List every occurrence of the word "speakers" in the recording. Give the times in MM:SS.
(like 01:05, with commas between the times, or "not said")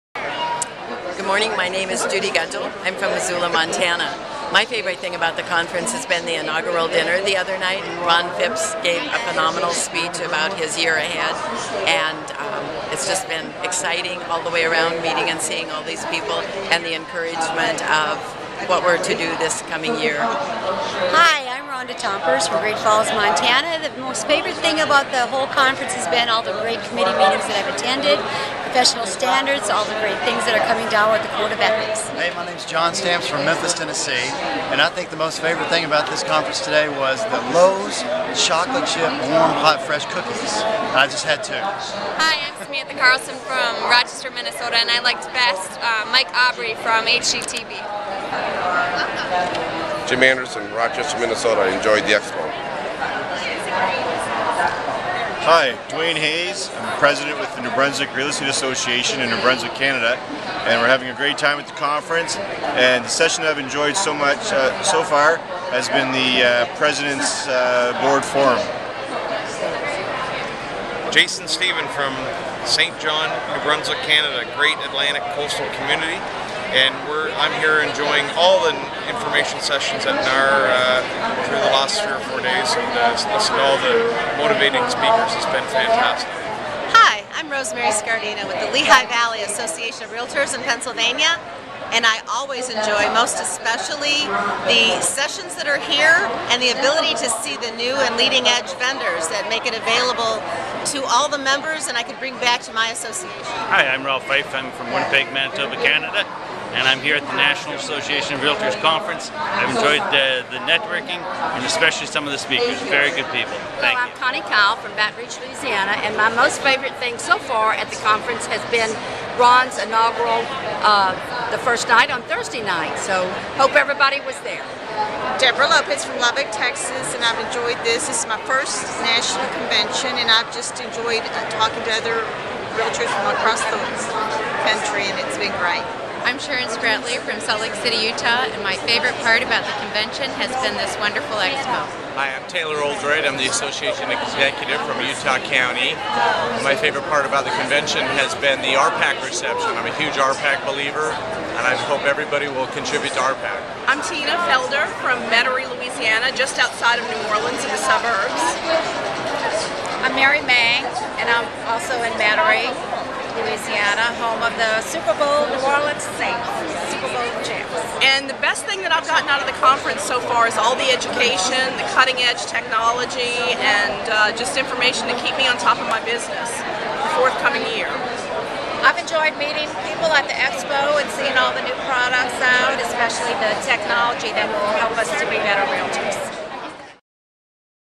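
01:24, 01:52.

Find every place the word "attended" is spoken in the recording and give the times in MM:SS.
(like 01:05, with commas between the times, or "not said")
00:27.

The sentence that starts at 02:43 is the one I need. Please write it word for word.
Louisiana, home of the Super Bowl New Orleans Saints, Super Bowl champs.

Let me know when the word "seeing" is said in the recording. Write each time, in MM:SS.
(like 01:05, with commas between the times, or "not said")
00:15, 03:01.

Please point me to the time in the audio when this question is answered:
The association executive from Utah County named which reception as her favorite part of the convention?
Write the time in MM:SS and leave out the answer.
02:28.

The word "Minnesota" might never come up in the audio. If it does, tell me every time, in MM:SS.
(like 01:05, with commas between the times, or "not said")
00:44, 00:51.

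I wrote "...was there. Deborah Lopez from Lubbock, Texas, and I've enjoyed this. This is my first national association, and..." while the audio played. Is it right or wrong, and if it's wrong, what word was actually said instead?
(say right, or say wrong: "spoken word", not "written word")
wrong: "convention", not "association".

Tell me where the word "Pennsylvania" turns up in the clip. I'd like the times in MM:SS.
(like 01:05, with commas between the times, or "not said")
01:30.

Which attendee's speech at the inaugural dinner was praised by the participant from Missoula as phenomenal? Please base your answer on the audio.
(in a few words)
Ron Phipps.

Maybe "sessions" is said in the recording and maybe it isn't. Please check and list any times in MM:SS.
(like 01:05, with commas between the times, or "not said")
01:03, 01:19, 01:35.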